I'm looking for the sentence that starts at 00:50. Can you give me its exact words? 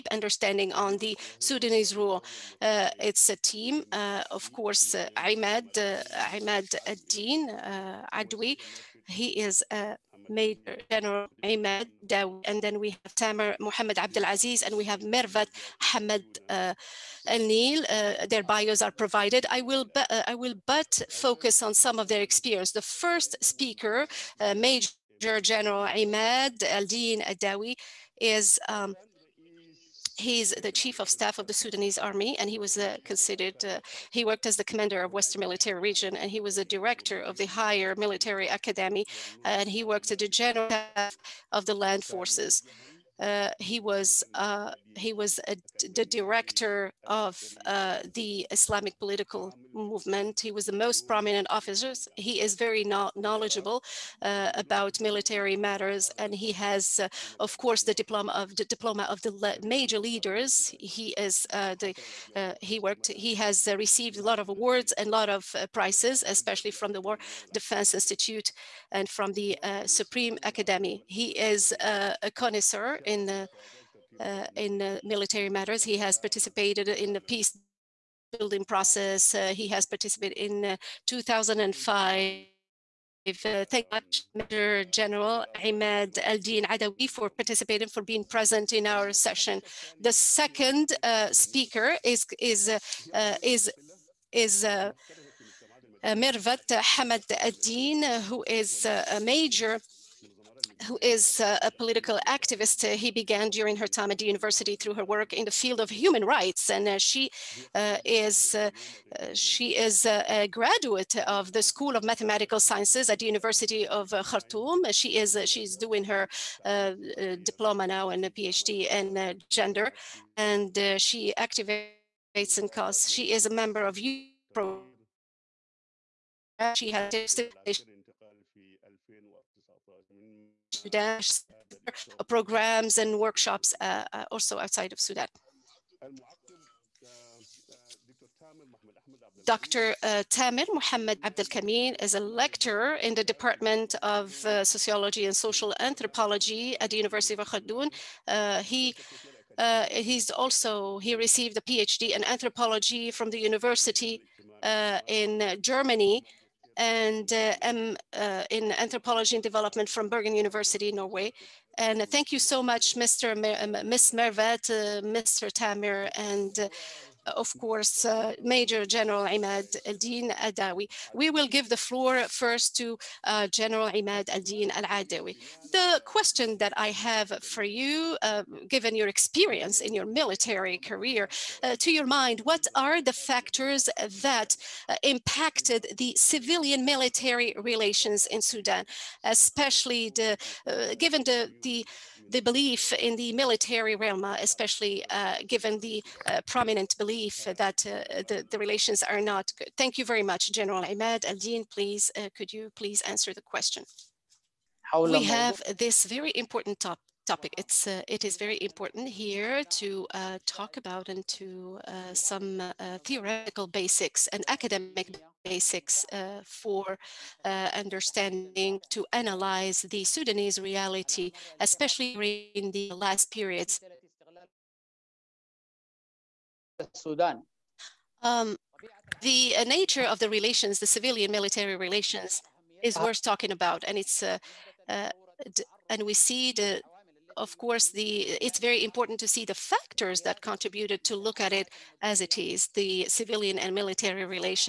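He was the most prominent officer.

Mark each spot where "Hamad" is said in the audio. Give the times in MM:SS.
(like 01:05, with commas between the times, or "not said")
00:15, 01:36.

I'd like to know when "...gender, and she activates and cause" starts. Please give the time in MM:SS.
01:59.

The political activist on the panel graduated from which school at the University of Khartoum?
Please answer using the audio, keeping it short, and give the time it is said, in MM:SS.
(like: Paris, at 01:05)
School of Mathematical Sciences, at 01:51.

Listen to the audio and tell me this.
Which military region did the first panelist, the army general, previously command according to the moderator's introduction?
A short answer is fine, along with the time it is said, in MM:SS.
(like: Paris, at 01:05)
Western Military Region, at 00:35.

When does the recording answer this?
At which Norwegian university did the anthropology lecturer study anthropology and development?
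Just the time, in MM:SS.
02:40.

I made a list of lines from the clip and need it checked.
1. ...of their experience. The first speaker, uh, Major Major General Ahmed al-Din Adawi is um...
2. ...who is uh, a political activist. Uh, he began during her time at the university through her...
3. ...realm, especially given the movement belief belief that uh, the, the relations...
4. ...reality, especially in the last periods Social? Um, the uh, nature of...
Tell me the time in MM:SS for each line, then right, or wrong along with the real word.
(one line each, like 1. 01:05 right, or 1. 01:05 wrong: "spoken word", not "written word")
1. 00:21 right
2. 01:40 right
3. 03:13 wrong: "prominent", not "movement"
4. 03:40 wrong: "Sudan", not "Social".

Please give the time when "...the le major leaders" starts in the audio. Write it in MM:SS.
00:59.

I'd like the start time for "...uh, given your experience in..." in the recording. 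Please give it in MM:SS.
02:58.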